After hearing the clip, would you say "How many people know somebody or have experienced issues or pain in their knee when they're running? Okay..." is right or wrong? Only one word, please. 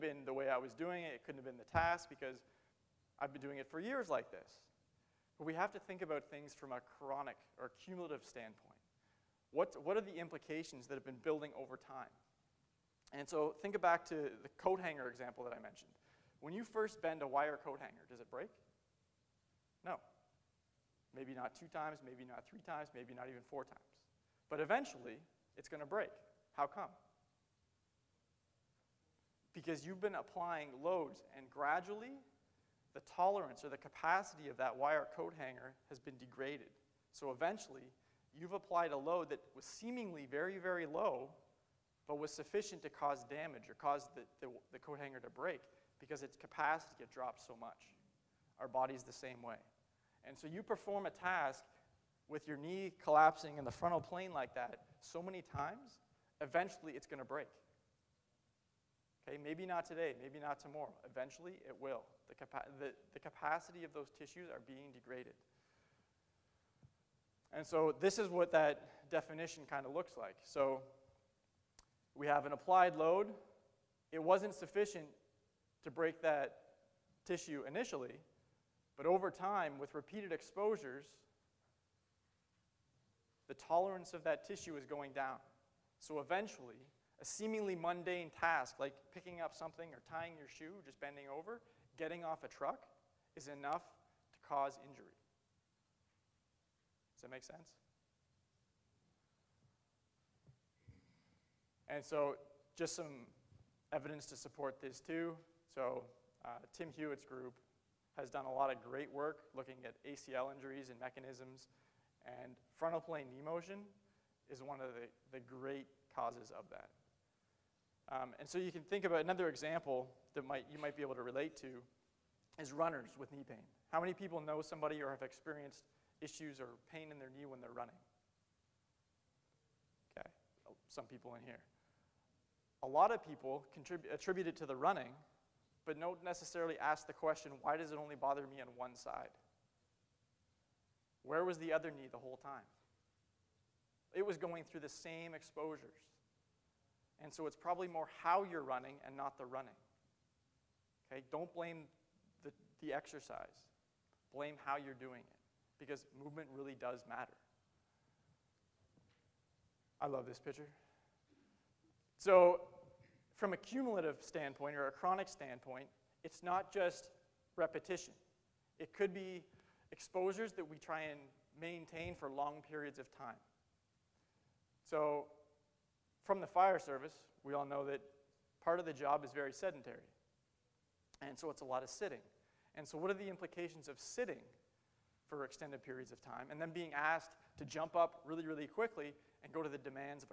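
right.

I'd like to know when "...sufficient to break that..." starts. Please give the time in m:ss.
1:14.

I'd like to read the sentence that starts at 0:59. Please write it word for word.
Okay, maybe not today, maybe not tomorrow.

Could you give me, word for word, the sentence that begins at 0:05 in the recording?
But we have to think about things from a chronic or cumulative standpoint.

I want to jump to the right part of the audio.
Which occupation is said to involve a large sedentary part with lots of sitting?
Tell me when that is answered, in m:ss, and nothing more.
2:56.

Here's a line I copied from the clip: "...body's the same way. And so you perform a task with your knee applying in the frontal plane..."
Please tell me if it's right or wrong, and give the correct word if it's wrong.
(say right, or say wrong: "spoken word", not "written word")
wrong: "collapsing", not "applying".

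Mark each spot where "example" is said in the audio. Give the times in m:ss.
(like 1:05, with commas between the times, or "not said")
0:15, 1:59.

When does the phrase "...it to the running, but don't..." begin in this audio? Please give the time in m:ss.
2:14.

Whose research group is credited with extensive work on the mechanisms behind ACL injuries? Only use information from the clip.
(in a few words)
Tim Hewett.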